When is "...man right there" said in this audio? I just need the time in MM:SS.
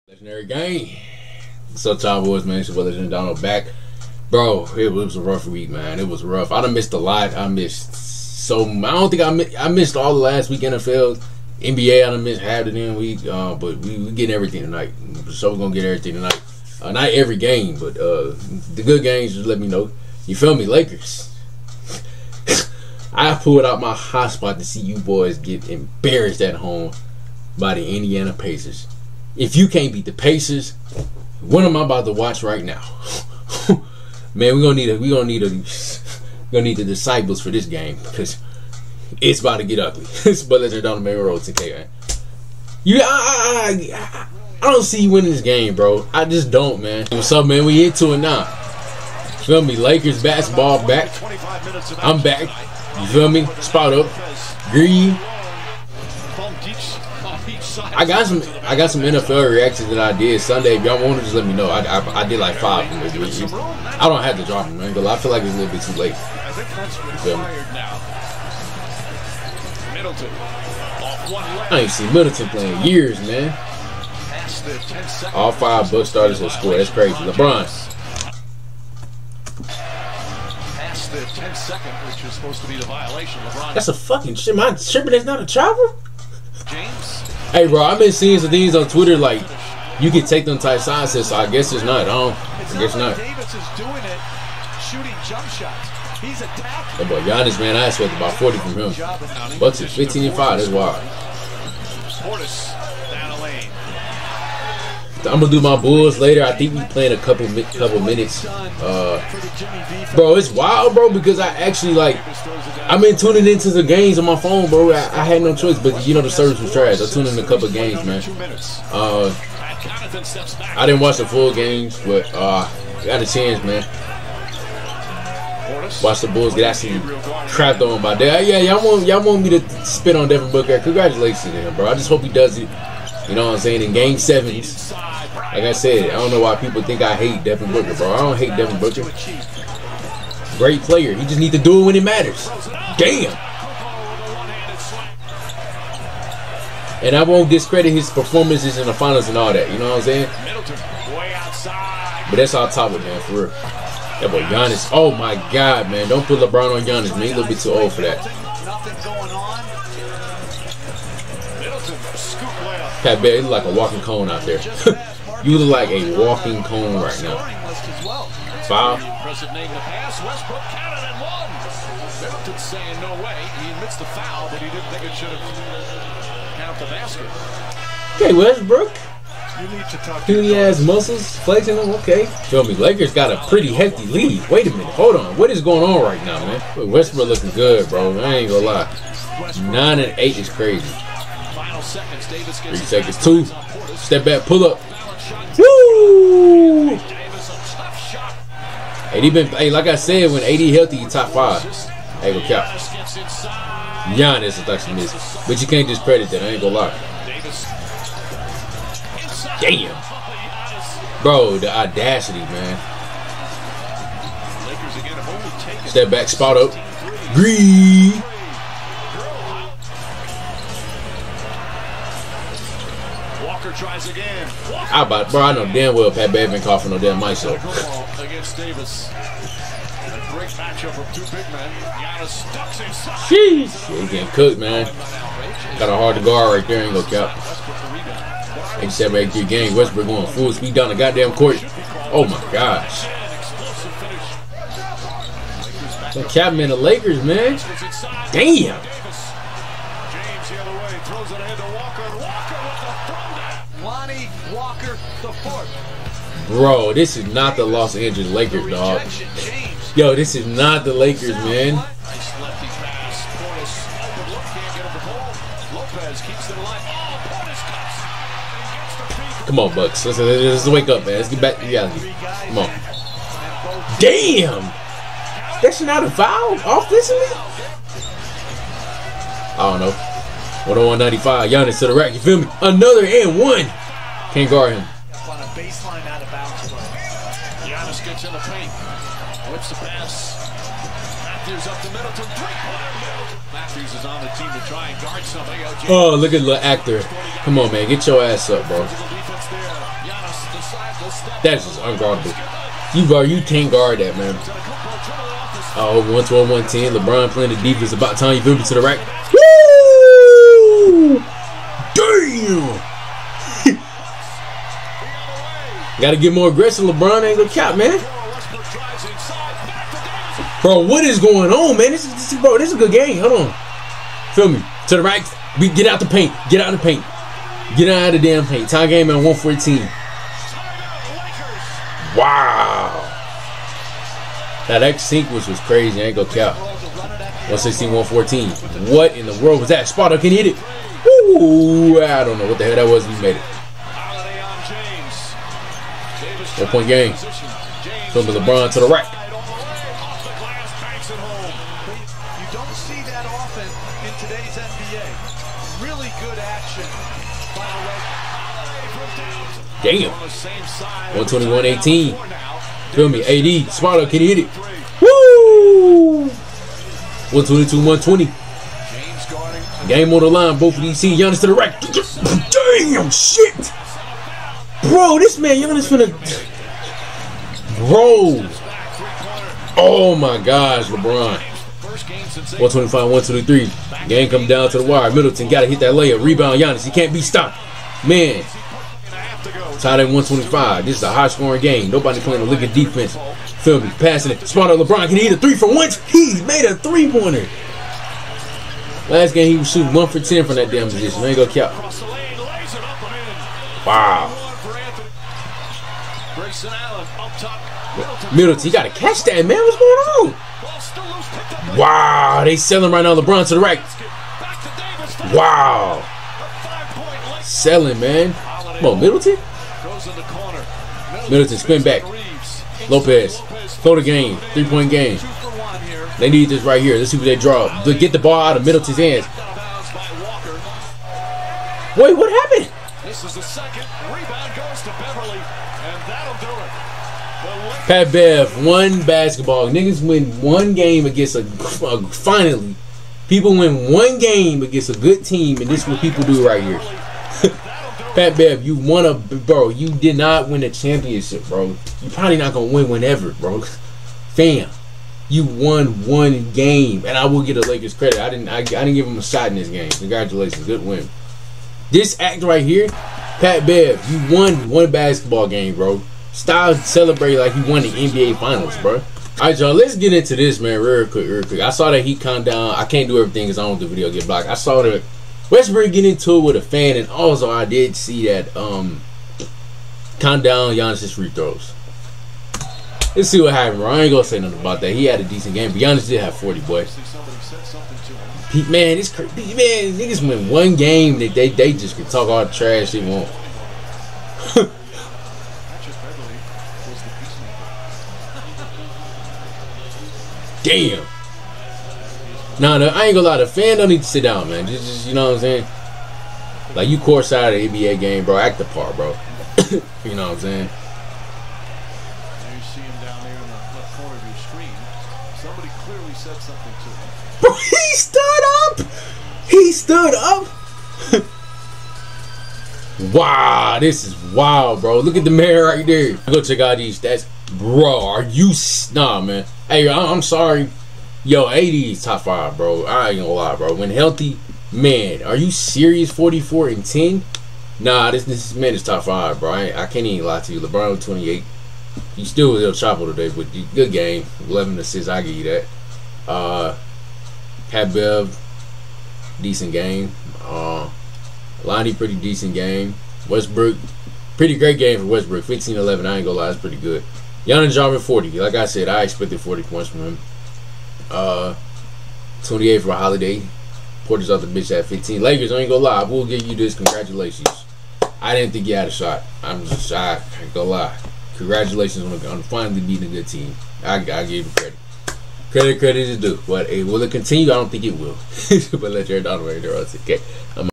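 08:45.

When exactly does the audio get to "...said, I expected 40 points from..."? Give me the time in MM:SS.
09:18.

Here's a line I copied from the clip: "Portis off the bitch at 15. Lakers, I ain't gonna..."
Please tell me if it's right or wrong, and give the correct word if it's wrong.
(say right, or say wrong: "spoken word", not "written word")
right.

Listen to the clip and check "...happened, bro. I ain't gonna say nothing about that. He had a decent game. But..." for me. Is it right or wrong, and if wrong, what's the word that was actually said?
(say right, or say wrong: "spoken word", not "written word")
right.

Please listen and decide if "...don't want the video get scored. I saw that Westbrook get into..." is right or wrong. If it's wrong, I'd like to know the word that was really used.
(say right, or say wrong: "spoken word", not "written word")
wrong: "blocked", not "scored".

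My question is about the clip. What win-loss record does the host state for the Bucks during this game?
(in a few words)
15 and 5.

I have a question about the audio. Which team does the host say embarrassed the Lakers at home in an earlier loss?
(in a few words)
Indiana Pacers.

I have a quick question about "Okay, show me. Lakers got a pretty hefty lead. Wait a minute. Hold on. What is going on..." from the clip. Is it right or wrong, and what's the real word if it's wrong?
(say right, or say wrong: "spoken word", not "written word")
right.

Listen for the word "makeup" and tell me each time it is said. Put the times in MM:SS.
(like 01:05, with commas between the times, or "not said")
not said.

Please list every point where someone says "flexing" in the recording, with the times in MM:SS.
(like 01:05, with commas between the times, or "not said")
03:01.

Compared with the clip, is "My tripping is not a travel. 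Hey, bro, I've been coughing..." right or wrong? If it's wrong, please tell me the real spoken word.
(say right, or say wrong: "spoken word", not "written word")
wrong: "seeing", not "coughing".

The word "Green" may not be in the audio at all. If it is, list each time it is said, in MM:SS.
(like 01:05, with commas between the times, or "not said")
00:54, 03:37.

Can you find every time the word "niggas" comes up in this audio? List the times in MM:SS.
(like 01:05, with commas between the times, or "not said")
07:19, 08:09.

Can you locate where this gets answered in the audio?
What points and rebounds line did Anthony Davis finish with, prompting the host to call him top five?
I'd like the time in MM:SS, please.
08:56.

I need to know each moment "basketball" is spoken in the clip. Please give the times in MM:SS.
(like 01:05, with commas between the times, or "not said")
00:50, 07:19, 07:44.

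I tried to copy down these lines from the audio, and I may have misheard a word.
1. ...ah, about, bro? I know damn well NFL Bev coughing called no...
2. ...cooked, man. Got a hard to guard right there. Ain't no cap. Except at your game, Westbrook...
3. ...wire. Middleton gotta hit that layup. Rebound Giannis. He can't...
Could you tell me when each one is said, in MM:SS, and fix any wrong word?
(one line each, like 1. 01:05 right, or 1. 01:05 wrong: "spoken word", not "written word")
1. 03:45 wrong: "Pat", not "NFL"
2. 03:54 right
3. 06:24 right.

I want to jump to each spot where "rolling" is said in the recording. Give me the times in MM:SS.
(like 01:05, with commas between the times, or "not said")
not said.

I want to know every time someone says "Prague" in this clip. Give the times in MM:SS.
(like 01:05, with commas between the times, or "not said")
not said.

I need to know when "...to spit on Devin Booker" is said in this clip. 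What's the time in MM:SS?
02:09.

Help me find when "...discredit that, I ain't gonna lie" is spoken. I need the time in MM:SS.
03:25.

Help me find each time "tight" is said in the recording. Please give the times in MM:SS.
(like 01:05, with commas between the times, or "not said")
01:30.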